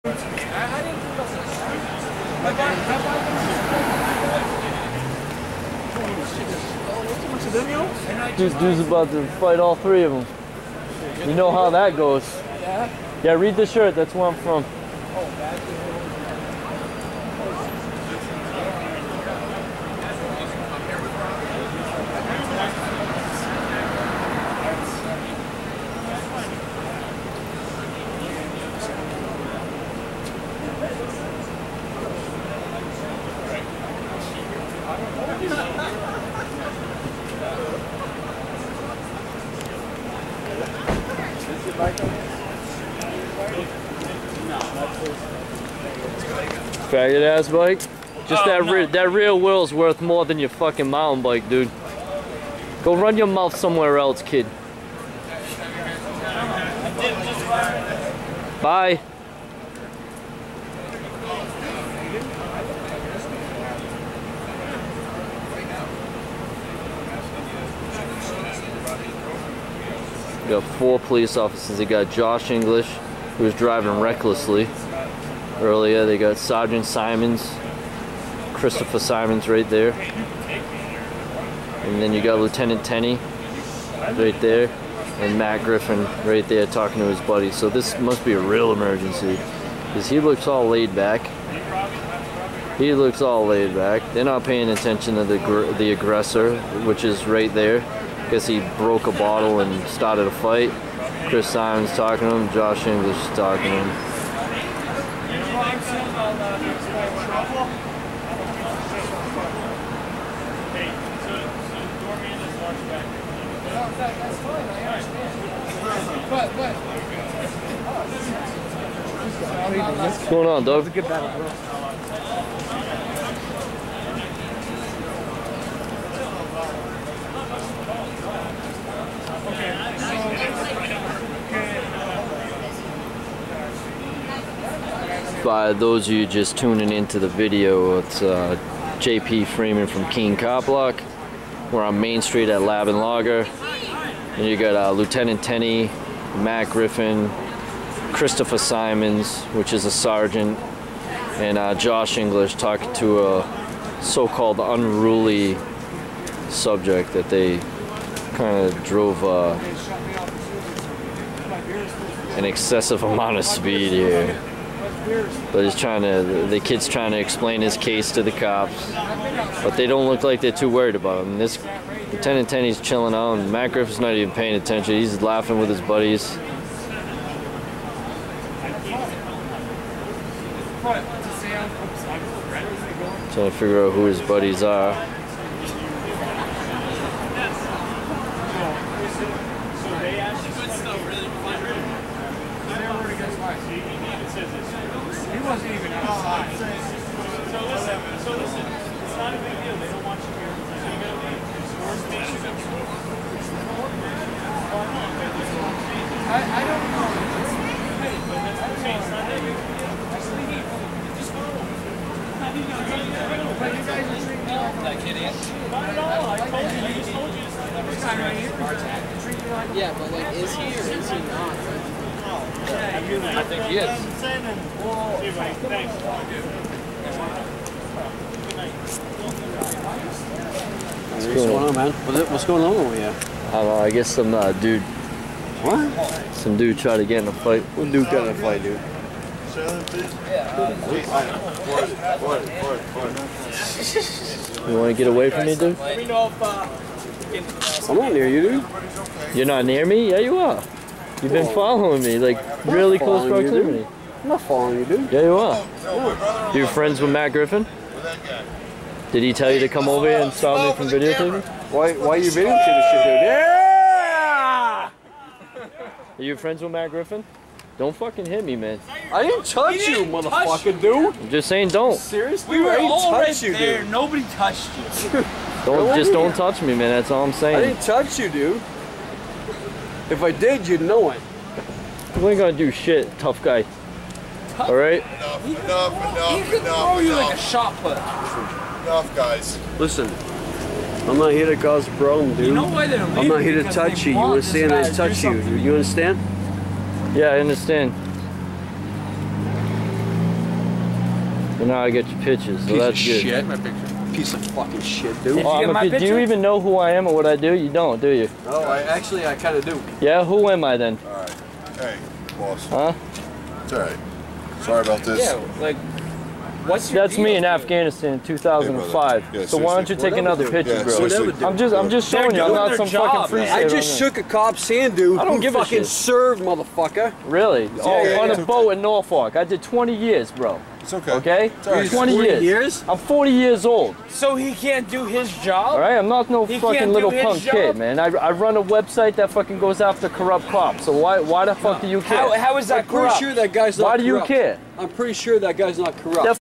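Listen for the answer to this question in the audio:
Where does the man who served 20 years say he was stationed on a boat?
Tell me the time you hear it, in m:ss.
5:28.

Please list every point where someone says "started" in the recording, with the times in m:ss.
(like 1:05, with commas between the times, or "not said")
1:39.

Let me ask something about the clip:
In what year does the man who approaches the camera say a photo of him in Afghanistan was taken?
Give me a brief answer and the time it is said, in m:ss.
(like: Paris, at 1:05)
2005, at 5:18.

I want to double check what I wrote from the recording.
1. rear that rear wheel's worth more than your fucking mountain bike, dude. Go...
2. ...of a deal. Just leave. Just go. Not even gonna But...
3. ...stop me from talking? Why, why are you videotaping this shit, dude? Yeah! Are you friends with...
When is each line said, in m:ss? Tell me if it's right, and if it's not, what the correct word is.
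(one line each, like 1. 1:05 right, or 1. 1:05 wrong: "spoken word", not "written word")
1. 0:48 right
2. 3:29 right
3. 4:20 wrong: "videotaping", not "talking".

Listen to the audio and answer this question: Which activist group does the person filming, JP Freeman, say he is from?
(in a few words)
Keene Cop Block.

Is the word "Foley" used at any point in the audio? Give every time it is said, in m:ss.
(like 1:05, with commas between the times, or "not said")
not said.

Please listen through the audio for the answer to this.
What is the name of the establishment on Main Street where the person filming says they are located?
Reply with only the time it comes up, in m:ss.
2:22.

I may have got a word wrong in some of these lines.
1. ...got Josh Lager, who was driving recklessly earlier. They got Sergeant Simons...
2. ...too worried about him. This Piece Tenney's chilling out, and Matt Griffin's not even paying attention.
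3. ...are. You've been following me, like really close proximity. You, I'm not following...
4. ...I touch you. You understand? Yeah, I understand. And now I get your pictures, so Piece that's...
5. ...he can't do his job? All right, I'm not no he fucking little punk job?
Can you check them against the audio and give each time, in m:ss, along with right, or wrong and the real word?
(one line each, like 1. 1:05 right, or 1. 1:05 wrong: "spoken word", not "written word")
1. 1:11 wrong: "English", not "Lager"
2. 2:50 wrong: "Lieutenant", not "Piece"
3. 4:10 right
4. 4:54 right
5. 5:34 right.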